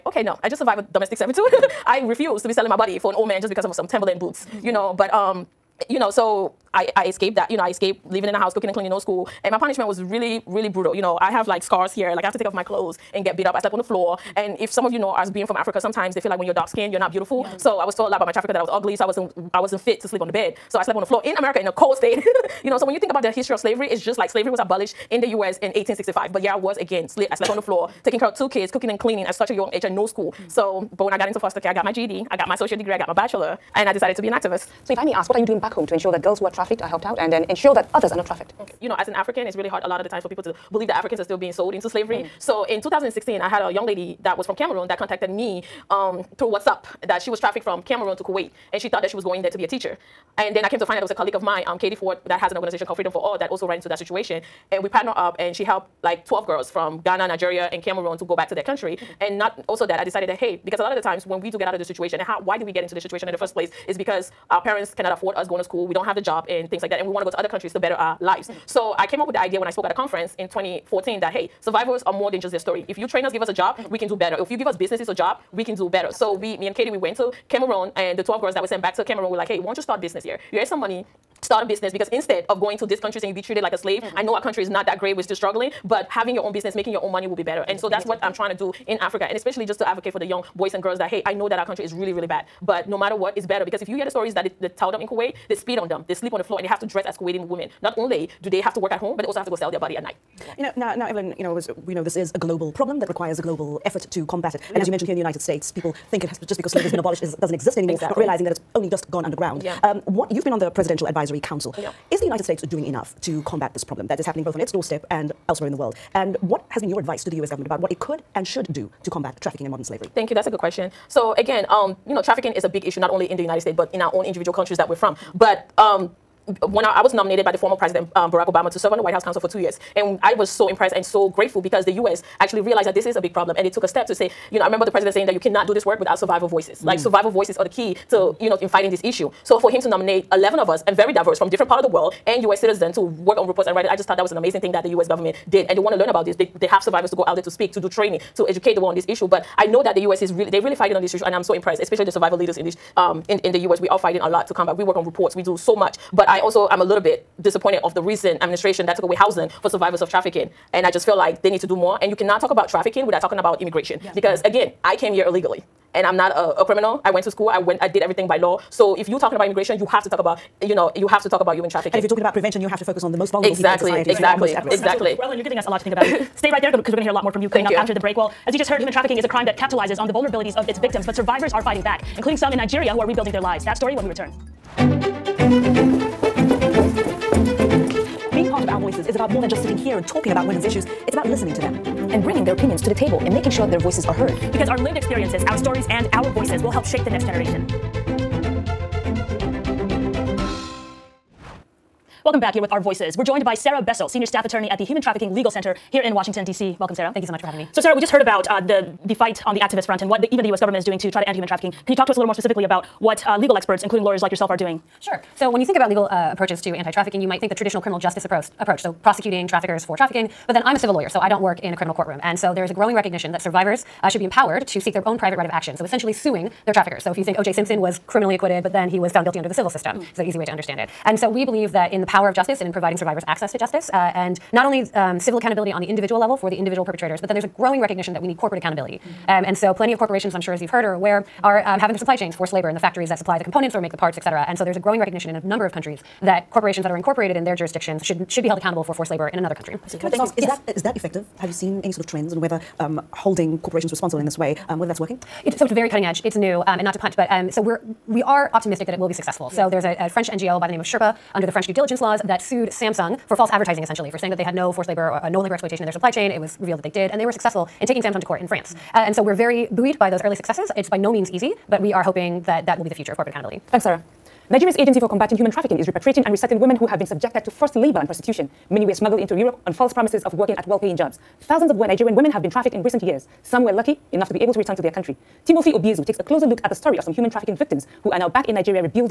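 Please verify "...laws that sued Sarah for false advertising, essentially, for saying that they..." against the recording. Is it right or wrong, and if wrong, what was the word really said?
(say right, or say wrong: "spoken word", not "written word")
wrong: "Samsung", not "Sarah".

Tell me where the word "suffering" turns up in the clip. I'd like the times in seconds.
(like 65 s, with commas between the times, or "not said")
not said.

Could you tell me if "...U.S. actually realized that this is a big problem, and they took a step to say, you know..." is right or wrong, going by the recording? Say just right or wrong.
right.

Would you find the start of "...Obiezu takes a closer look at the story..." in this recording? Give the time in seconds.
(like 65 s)
285 s.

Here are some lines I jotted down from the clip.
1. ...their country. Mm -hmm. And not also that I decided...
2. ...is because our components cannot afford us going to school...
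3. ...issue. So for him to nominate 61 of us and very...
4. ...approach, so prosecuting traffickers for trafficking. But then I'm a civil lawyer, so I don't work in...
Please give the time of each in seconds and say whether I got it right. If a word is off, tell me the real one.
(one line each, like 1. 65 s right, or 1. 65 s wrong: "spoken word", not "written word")
1. 58 s right
2. 63 s wrong: "parents", not "components"
3. 139 s wrong: "11", not "61"
4. 218 s right.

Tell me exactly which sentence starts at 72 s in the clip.
If you train us, give us a job, mm -hmm.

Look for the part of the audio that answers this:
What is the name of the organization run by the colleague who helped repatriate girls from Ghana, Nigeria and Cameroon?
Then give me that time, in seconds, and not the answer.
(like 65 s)
52 s.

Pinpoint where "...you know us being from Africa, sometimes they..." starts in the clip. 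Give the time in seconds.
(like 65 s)
14 s.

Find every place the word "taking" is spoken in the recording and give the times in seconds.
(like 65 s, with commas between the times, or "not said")
28 s, 267 s.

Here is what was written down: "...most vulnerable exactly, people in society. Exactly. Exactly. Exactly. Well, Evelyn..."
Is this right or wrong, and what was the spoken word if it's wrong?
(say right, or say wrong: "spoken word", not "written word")
right.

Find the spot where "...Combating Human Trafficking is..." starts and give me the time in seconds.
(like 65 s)
275 s.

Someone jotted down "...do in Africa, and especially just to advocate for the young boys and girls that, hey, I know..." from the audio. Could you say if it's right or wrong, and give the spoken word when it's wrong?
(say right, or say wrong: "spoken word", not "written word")
right.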